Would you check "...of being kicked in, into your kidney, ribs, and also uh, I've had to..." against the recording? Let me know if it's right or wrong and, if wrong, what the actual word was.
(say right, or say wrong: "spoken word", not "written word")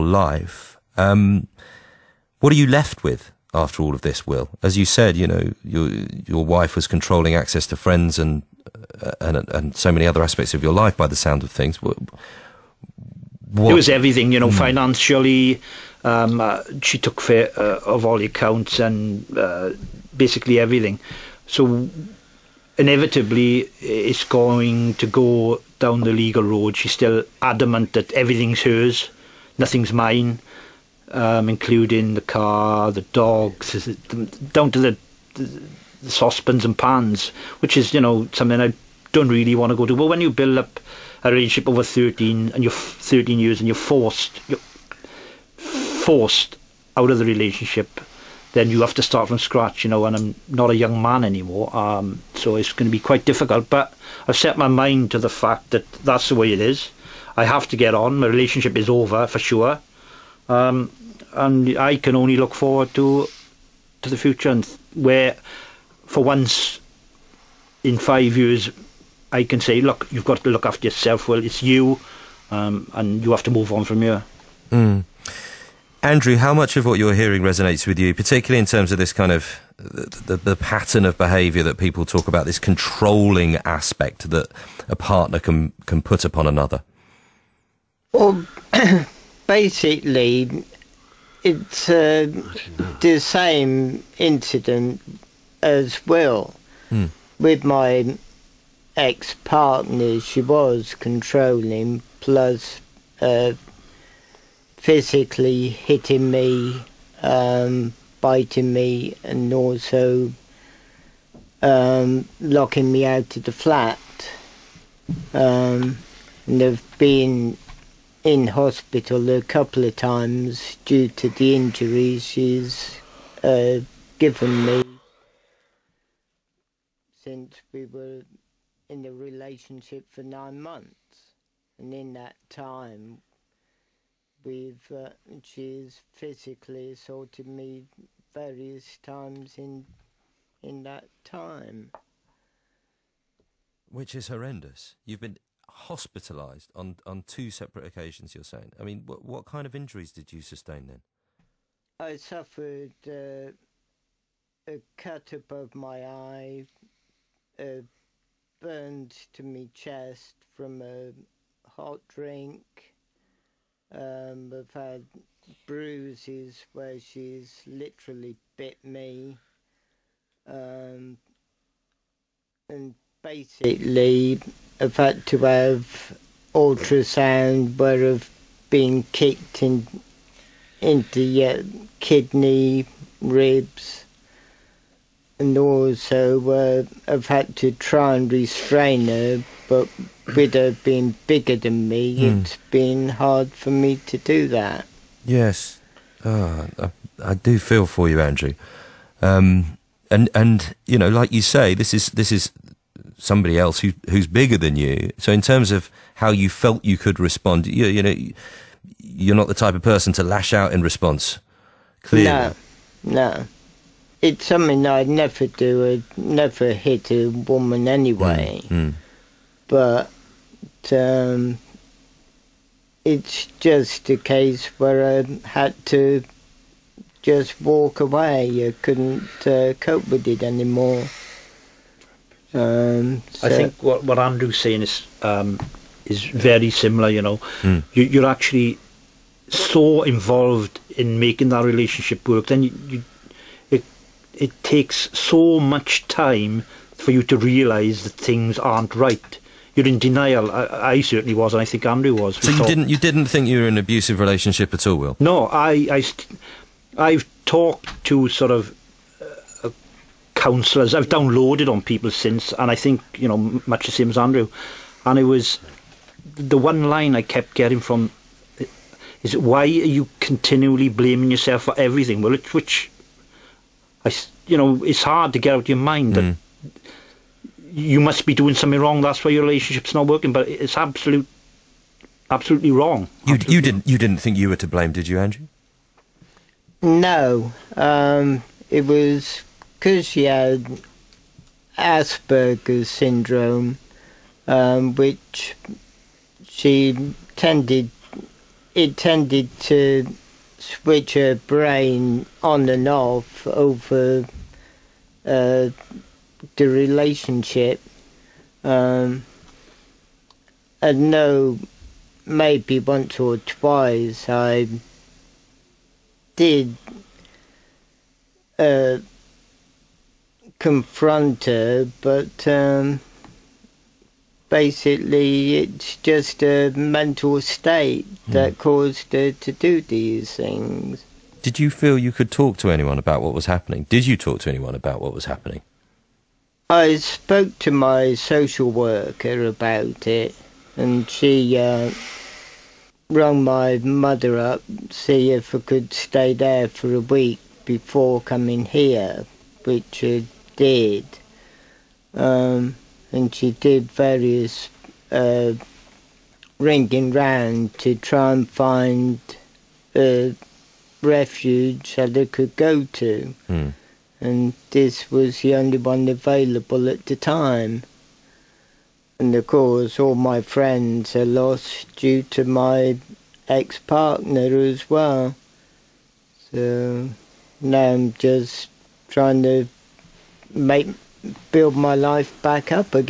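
right.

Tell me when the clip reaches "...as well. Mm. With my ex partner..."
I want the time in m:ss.
1:35.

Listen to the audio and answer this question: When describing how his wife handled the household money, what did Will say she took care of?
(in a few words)
all the accounts.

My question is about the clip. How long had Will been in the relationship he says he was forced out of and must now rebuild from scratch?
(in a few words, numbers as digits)
13 years.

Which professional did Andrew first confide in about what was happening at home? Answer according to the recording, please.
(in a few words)
social worker.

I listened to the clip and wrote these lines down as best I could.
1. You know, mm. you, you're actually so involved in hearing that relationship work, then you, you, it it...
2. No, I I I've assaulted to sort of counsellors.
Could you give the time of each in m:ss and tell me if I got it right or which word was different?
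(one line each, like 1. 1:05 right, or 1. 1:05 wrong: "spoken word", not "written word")
1. 3:57 wrong: "making", not "hearing"
2. 4:15 wrong: "talked", not "assaulted".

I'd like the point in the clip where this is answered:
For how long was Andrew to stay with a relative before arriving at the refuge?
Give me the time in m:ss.
5:46.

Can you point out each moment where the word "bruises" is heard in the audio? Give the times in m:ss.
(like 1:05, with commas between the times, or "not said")
2:45.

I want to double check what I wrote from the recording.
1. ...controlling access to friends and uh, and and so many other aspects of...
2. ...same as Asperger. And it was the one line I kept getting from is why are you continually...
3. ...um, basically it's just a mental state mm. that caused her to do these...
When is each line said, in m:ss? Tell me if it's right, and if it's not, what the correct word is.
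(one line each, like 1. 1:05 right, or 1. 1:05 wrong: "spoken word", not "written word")
1. 0:06 right
2. 4:23 wrong: "Andrew", not "Asperger"
3. 5:22 right.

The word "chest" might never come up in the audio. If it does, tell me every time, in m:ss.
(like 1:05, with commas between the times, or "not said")
2:39.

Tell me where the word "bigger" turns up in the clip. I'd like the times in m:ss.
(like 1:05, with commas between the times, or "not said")
3:11, 3:24.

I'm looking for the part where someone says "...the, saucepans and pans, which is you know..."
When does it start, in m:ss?
0:35.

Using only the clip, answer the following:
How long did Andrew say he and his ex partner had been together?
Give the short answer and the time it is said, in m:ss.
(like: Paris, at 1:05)
9 months, at 2:10.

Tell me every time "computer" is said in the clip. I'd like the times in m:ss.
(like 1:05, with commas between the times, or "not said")
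not said.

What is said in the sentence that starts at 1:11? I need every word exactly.
Well, it's you, um, and you have to move on from here.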